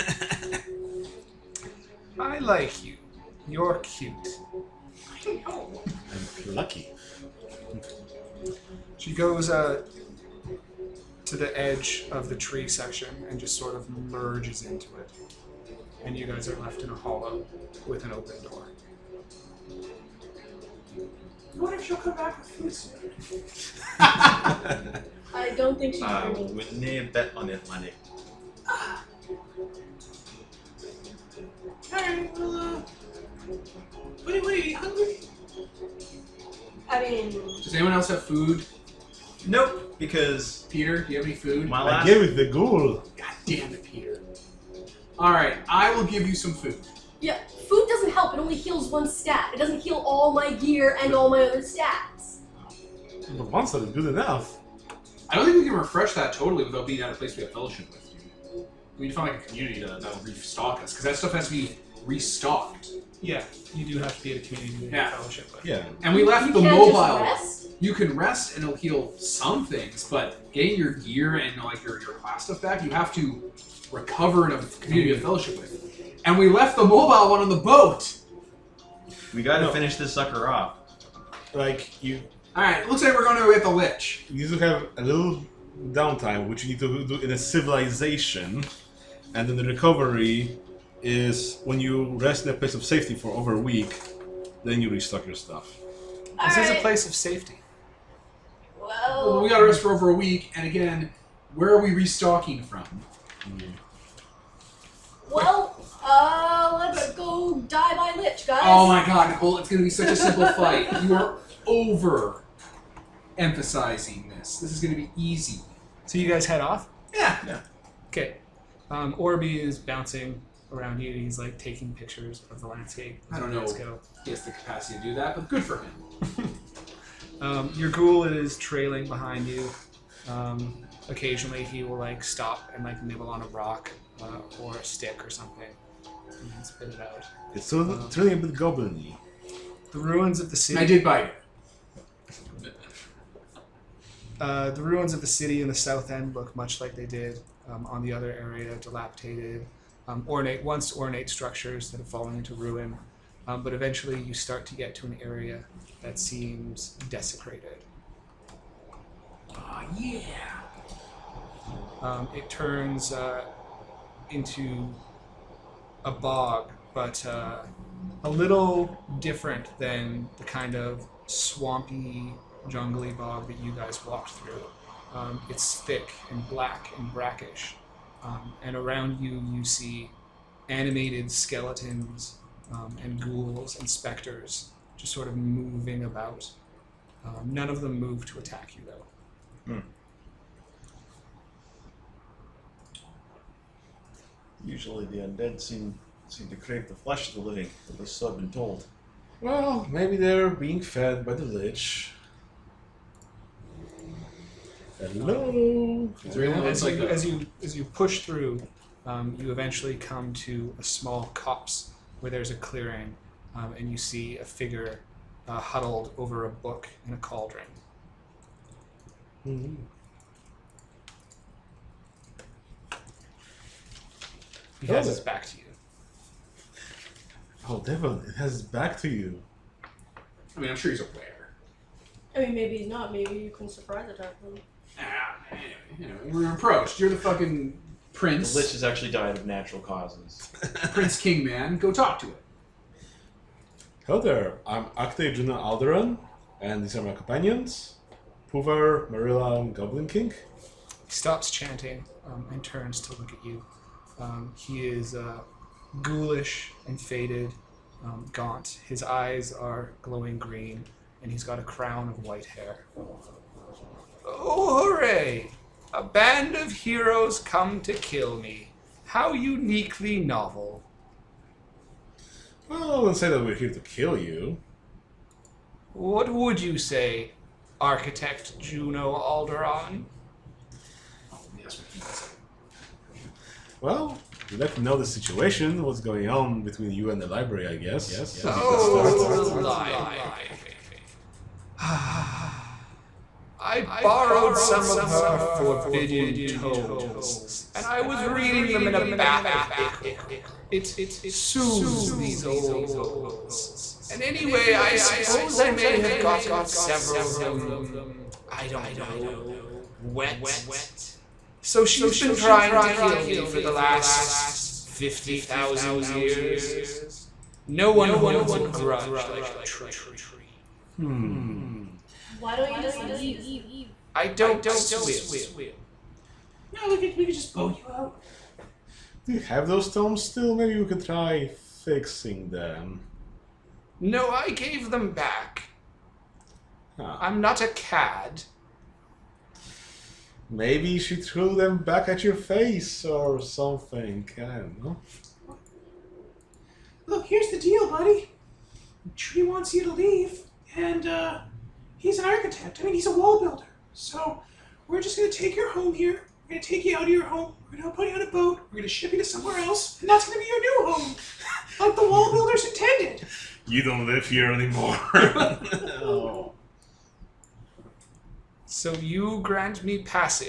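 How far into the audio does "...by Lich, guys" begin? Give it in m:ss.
1:47.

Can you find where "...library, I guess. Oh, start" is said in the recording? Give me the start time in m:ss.
4:47.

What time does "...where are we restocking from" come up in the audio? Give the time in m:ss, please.
1:41.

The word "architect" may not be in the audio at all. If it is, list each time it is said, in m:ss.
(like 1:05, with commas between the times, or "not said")
4:37, 5:52.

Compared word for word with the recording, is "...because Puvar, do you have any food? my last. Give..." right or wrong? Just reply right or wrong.
wrong.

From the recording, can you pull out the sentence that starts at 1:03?
Yeah, you do have to be at a community to yeah.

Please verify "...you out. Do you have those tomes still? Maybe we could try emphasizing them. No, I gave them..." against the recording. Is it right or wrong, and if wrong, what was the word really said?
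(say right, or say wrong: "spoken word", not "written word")
wrong: "fixing", not "emphasizing".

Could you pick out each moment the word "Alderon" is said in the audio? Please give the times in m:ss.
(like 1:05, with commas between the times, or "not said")
4:05, 4:39.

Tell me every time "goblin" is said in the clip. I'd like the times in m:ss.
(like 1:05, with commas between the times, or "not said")
2:18, 4:09.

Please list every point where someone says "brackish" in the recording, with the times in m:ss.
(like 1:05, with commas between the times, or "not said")
2:57.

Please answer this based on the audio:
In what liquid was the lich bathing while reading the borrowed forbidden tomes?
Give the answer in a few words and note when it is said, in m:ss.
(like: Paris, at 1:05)
Ichor, at 4:59.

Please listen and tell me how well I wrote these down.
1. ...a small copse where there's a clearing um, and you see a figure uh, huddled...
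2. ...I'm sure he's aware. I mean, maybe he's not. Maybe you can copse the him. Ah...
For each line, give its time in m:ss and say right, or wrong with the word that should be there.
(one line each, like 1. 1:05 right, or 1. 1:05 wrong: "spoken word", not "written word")
1. 3:30 right
2. 3:50 wrong: "surprise", not "copse".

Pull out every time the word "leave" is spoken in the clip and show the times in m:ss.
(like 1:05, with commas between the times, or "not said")
5:22, 5:49.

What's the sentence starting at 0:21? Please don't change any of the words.
What if she'll come back with food soon?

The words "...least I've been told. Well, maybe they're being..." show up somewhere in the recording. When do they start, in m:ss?
3:17.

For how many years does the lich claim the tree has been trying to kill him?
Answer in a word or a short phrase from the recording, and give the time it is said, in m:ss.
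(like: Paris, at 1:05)
50,000, at 5:14.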